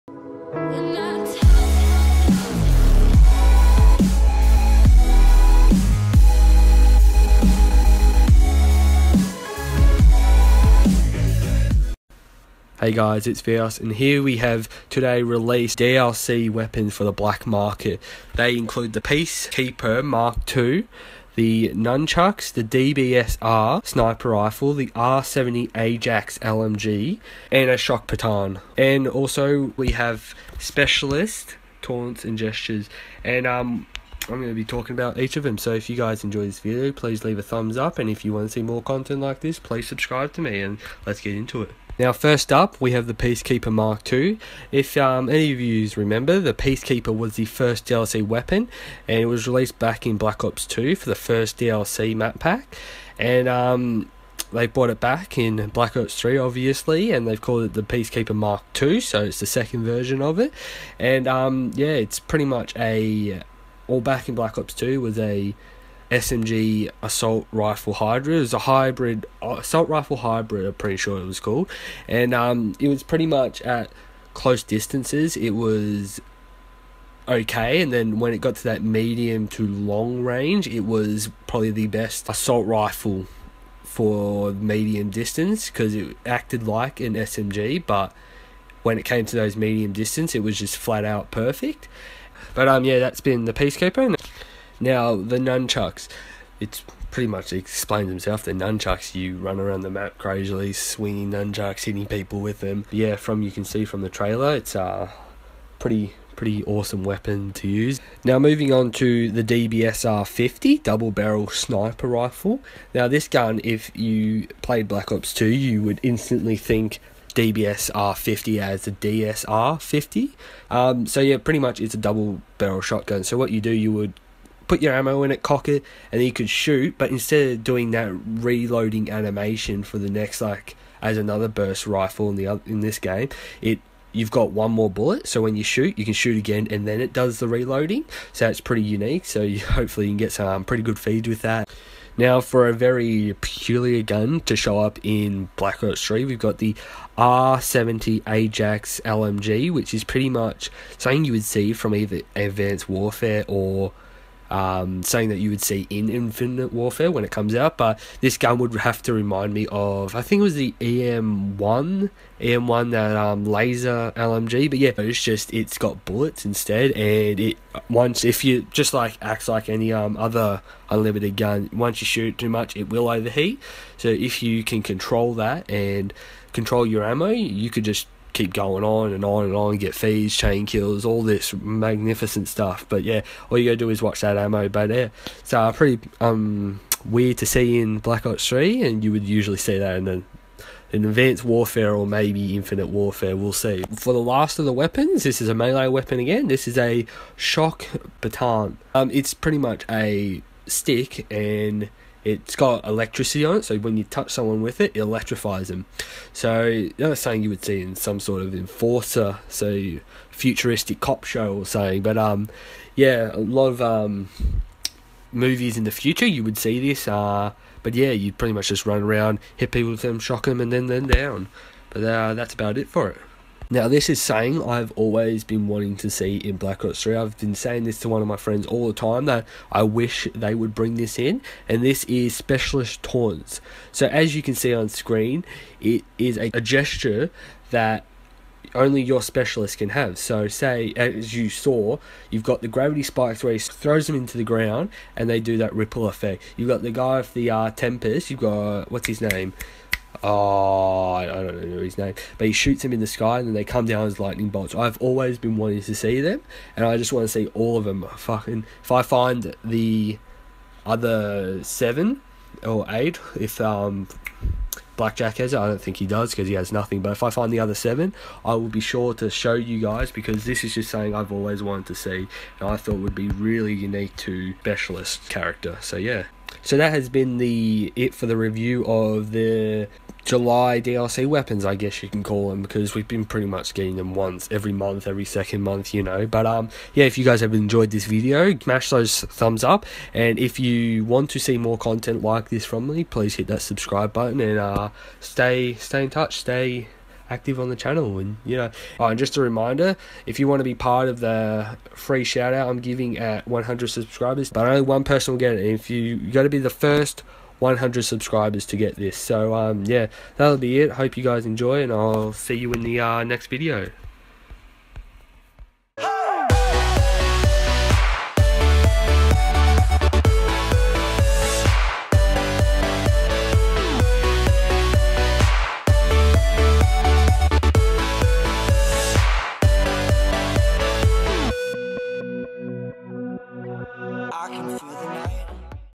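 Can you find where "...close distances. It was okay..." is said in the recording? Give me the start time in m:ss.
1:14.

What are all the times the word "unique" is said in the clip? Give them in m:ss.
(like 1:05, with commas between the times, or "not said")
2:18, 4:33.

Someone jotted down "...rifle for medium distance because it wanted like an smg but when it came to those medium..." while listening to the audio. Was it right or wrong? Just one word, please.
wrong.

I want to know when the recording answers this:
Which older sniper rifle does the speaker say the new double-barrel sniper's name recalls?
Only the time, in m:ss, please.
1:58.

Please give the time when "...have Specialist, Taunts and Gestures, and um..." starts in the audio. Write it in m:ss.
0:29.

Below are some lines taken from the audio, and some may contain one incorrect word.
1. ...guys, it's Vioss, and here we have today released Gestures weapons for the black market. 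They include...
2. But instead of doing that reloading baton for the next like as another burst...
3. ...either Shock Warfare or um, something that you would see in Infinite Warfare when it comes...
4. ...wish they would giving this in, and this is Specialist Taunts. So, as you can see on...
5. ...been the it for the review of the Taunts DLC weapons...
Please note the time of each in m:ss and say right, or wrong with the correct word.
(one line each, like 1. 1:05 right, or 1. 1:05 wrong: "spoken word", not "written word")
1. 0:12 wrong: "DLC", not "Gestures"
2. 2:06 wrong: "animation", not "baton"
3. 2:31 wrong: "Advanced", not "Shock"
4. 3:49 wrong: "bring", not "giving"
5. 4:37 wrong: "July", not "Taunts".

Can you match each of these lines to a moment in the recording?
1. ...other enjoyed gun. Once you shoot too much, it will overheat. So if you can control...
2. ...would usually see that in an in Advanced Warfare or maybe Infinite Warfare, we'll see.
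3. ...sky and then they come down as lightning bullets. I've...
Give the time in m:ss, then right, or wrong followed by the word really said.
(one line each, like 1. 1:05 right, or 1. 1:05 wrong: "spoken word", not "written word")
1. 2:50 wrong: "unlimited", not "enjoyed"
2. 3:09 right
3. 4:13 wrong: "bolts", not "bullets".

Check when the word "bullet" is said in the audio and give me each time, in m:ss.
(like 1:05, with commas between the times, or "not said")
2:14, 2:46.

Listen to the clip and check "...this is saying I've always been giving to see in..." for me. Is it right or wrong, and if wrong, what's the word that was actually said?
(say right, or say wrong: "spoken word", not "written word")
wrong: "wanting", not "giving".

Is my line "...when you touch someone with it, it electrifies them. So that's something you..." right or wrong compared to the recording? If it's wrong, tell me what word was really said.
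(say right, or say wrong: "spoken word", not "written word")
right.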